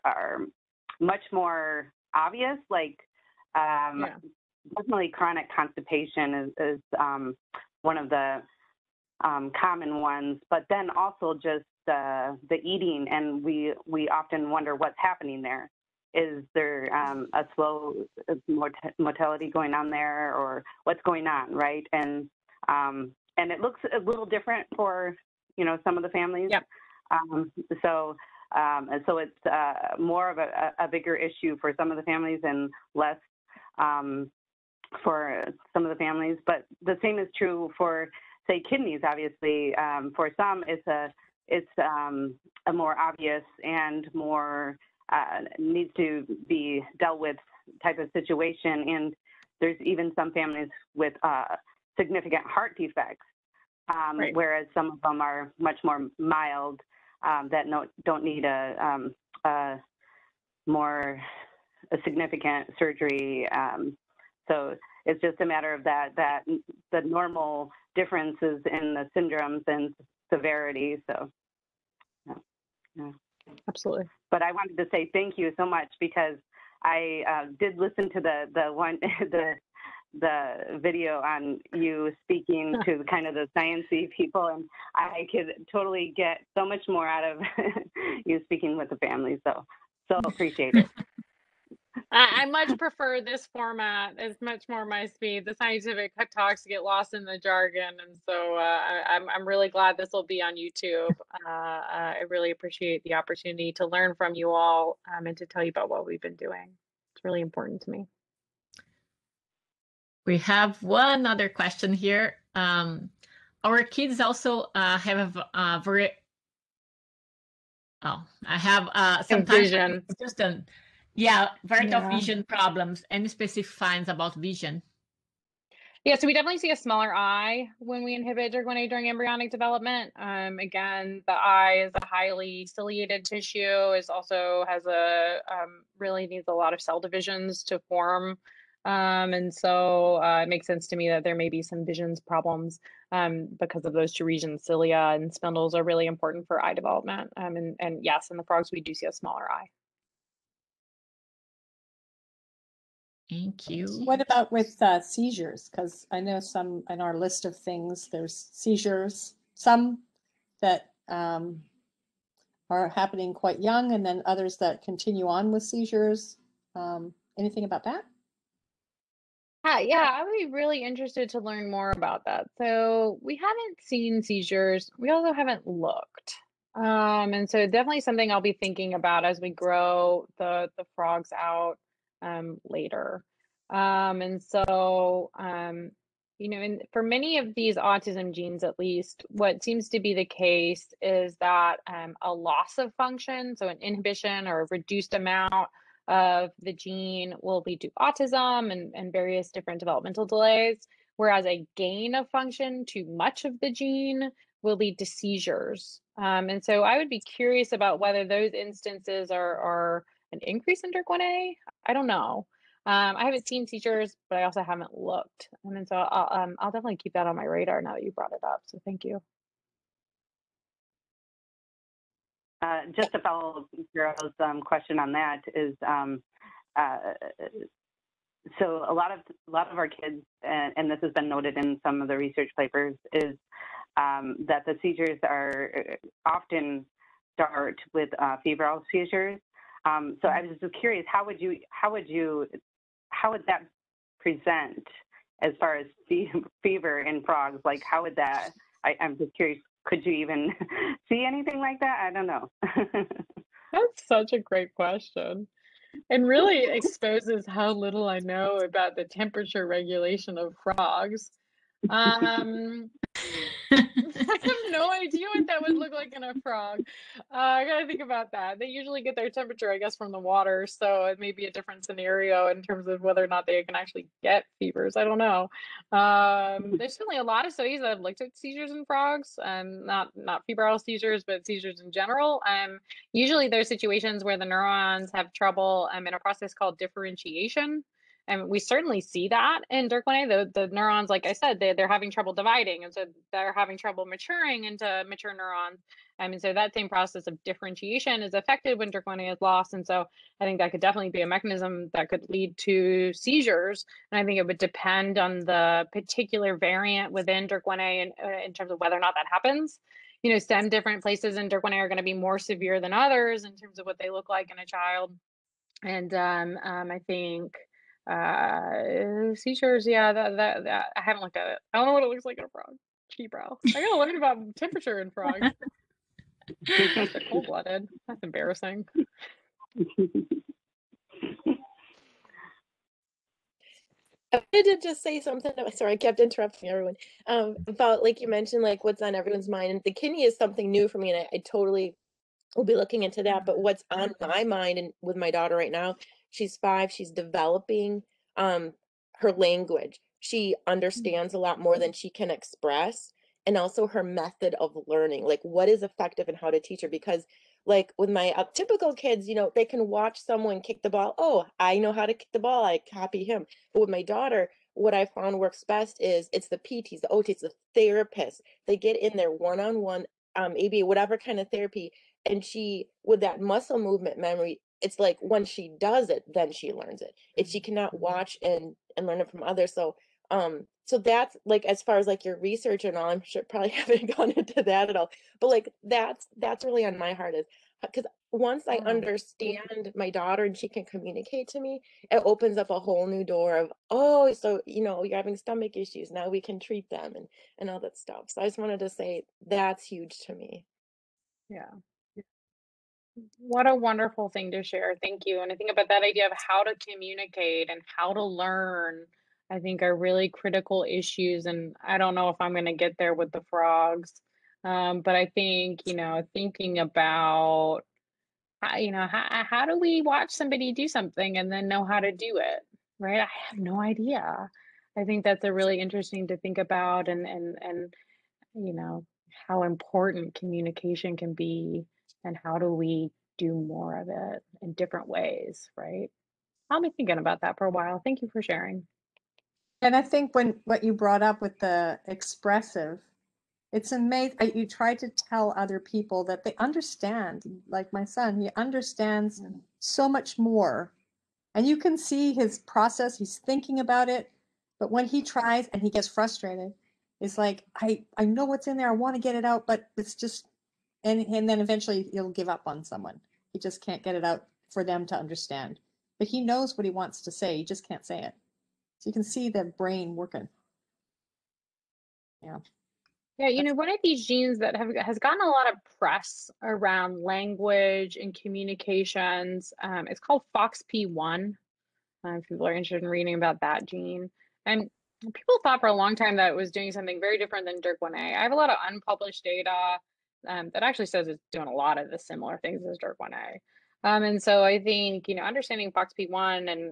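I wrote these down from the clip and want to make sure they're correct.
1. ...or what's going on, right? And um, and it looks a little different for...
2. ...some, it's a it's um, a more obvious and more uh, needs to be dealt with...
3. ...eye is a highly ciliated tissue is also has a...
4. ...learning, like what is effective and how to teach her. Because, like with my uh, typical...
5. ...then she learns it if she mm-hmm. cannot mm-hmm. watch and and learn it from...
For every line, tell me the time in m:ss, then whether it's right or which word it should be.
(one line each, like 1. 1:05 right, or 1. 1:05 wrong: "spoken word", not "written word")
1. 0:20 right
2. 0:40 right
3. 2:11 right
4. 5:54 right
5. 6:16 right.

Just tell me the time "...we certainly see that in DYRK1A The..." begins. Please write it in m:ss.
4:48.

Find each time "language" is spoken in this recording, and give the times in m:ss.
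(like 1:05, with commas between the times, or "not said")
5:49, 7:57.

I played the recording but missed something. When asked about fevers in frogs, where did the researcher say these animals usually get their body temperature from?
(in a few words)
the water.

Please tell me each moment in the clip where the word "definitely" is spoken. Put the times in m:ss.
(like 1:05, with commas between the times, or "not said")
0:04, 2:06, 2:57, 3:36, 5:00.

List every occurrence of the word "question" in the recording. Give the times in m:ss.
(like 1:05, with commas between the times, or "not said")
1:51, 3:44, 4:14.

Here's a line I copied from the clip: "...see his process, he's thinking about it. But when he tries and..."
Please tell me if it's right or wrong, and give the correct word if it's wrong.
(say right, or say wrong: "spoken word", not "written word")
right.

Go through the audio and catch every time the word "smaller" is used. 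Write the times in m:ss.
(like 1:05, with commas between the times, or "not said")
2:06, 2:29.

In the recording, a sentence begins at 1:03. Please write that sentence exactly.
Um, so it's just a matter of that that the normal differences in the syndromes and severity.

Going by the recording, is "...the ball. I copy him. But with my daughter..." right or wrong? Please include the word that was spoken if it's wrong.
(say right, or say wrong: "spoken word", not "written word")
right.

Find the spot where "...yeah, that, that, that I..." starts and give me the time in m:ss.
5:19.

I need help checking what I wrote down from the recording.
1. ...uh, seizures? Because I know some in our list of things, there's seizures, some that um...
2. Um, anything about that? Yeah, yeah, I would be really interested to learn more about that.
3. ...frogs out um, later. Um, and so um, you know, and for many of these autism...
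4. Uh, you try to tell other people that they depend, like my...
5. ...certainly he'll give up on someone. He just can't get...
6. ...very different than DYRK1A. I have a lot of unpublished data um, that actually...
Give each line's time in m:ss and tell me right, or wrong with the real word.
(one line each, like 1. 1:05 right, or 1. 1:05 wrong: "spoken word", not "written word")
1. 2:34 right
2. 2:46 right
3. 3:00 right
4. 7:24 wrong: "understand", not "depend"
5. 7:41 wrong: "eventually", not "certainly"
6. 8:07 right.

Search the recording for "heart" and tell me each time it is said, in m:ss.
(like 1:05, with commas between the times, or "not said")
0:52, 6:27.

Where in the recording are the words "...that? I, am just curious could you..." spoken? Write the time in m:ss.
4:08.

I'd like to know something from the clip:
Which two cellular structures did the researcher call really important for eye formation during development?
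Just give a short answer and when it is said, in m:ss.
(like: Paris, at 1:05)
cilia and spindles, at 2:24.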